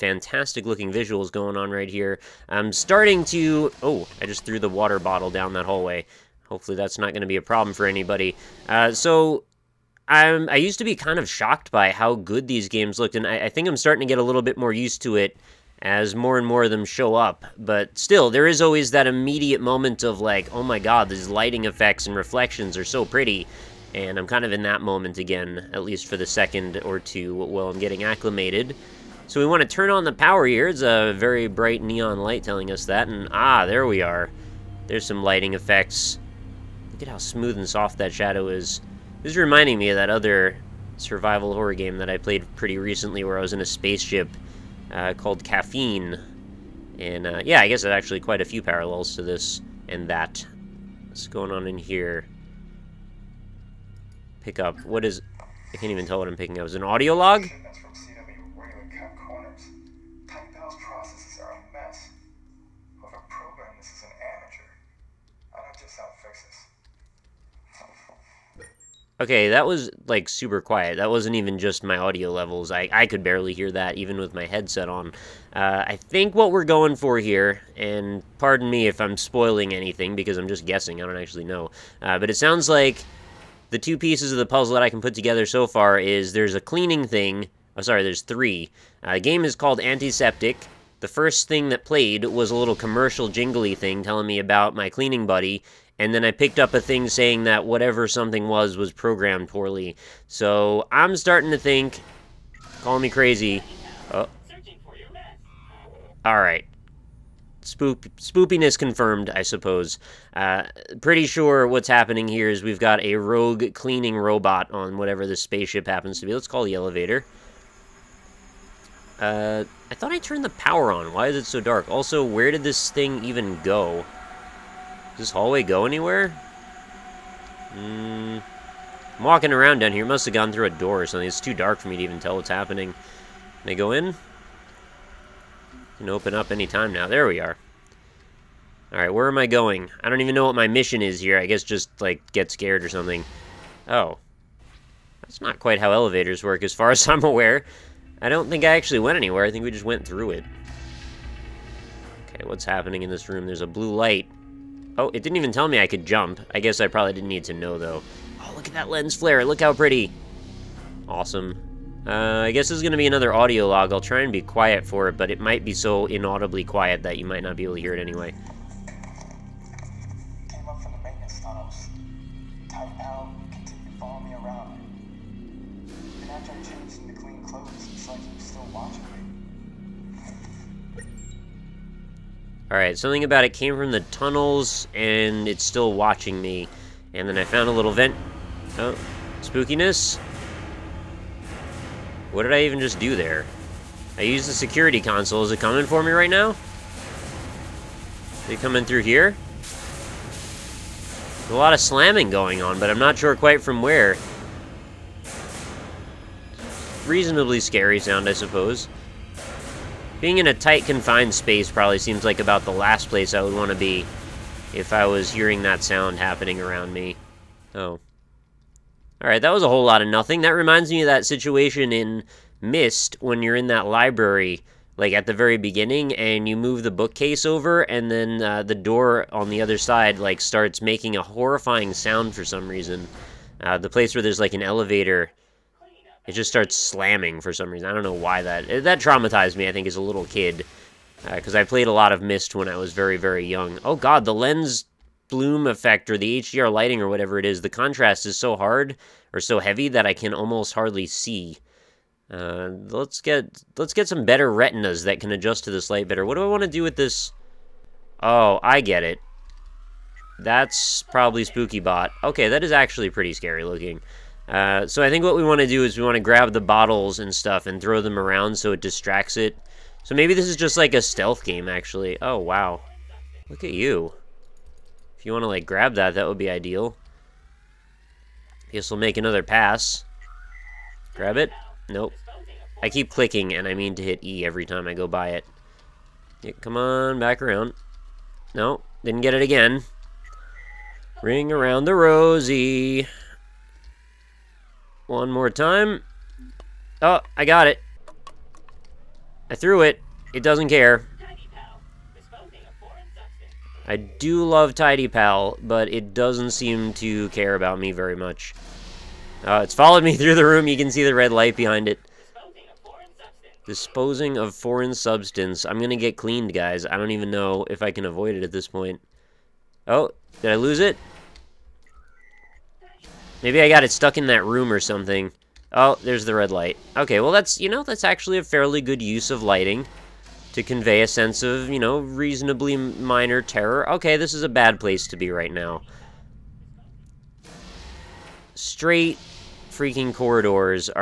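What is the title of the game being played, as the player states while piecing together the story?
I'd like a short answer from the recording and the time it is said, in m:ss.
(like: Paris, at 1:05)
Antiseptic, at 1:29.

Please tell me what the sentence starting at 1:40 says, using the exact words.
So I'm starting to think, call me crazy.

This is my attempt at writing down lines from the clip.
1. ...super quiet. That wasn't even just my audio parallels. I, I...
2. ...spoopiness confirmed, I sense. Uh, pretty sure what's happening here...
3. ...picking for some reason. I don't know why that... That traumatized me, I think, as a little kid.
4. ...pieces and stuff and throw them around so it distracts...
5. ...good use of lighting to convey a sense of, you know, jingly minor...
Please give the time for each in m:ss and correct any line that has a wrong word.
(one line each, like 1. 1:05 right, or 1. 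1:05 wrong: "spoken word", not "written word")
1. 1:10 wrong: "levels", not "parallels"
2. 1:48 wrong: "suppose", not "sense"
3. 3:56 wrong: "slamming", not "picking"
4. 4:26 wrong: "bottles", not "pieces"
5. 5:28 wrong: "reasonably", not "jingly".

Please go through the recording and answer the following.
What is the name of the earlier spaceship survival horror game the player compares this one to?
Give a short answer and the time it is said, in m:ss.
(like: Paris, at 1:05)
Caffeine, at 0:45.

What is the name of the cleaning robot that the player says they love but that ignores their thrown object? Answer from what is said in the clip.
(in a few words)
Tidy Pal.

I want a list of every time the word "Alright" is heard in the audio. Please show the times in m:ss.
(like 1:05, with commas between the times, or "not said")
2:18, 3:02, 3:39.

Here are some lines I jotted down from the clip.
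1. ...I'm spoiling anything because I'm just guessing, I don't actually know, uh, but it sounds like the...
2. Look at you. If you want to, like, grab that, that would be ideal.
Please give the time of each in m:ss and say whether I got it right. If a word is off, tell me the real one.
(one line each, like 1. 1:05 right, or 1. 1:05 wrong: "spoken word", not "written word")
1. 1:18 right
2. 4:33 right.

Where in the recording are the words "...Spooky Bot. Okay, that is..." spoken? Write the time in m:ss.
4:21.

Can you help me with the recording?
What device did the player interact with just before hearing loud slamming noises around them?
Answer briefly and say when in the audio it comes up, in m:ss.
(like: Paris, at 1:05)
security console, at 3:14.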